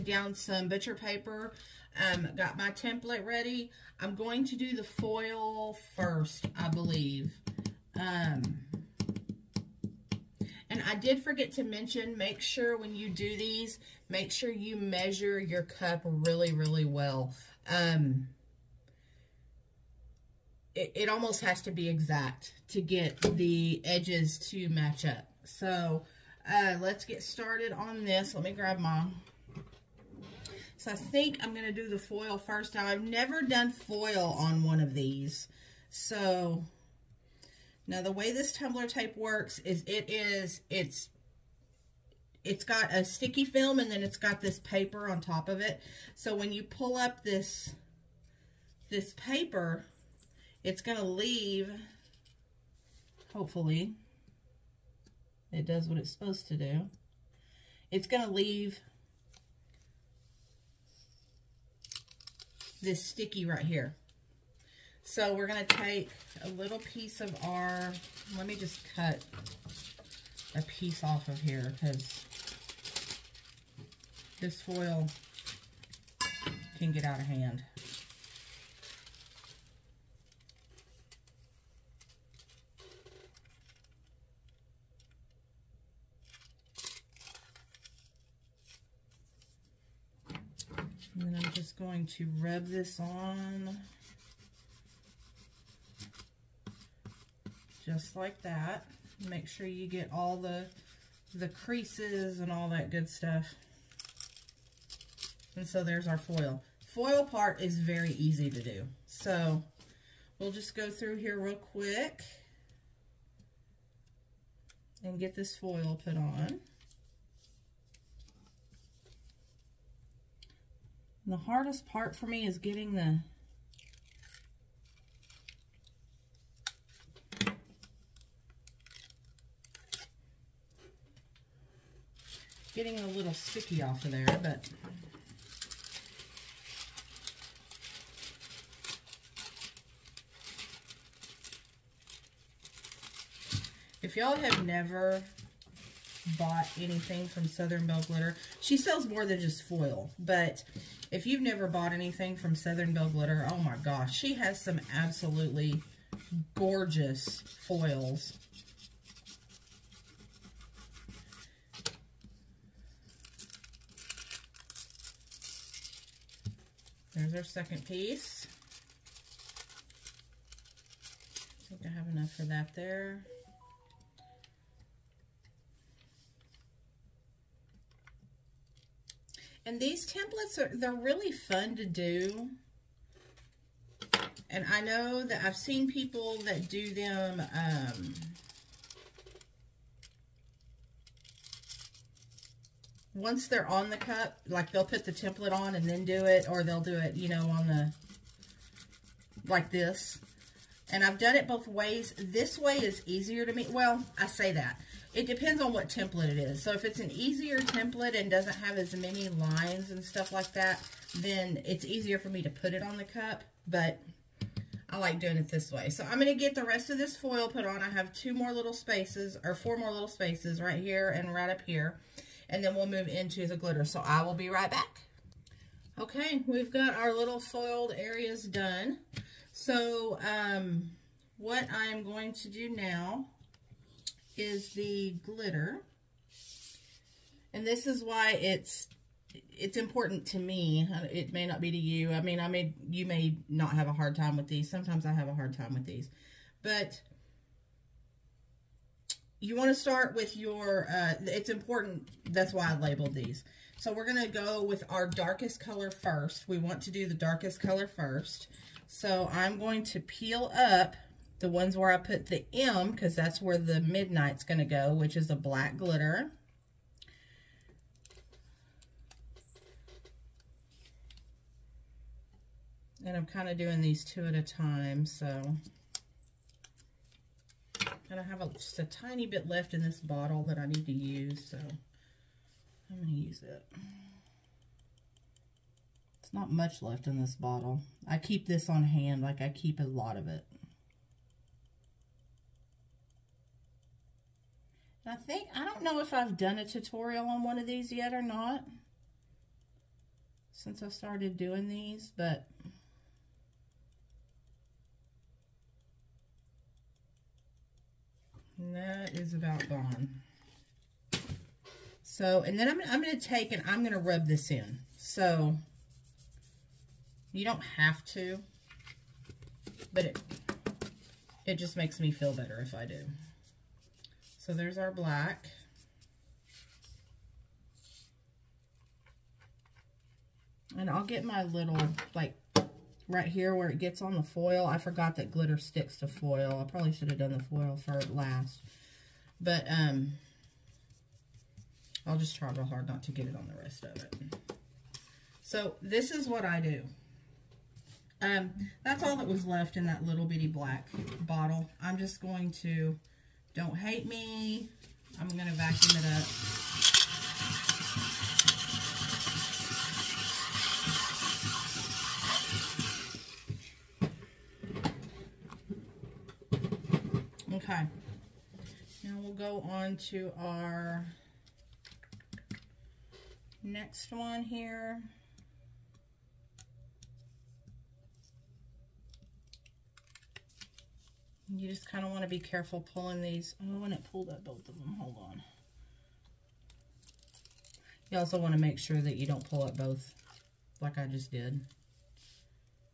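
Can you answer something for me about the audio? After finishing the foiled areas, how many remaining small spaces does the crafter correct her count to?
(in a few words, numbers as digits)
4.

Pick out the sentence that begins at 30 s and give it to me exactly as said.
So I think I'm going to do the foil first.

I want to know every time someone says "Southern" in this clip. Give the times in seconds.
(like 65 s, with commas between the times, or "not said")
147 s, 152 s.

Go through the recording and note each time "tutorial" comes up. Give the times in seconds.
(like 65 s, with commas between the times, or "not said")
296 s.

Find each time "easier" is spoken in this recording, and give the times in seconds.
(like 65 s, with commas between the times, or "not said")
203 s, 207 s, 211 s.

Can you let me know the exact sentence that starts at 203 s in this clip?
Well, I say that it depends on what template it is.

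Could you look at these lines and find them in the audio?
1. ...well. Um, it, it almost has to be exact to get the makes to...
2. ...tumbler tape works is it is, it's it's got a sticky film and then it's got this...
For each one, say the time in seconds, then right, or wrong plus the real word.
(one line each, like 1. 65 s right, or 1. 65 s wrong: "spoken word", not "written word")
1. 16 s wrong: "edges", not "makes"
2. 38 s right.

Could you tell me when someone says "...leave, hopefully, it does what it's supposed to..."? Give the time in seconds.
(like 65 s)
51 s.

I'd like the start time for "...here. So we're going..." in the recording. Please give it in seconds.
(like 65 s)
63 s.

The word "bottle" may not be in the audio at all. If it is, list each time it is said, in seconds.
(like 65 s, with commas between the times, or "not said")
280 s, 287 s, 351 s.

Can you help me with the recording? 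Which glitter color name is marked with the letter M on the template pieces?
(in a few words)
Midnight.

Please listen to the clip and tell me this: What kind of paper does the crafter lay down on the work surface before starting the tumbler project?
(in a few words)
Butcher paper.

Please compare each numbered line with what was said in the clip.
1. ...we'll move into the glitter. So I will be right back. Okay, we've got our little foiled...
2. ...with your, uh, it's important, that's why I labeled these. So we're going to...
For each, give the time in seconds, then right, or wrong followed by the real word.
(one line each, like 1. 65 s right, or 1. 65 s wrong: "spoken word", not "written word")
1. 222 s right
2. 250 s right.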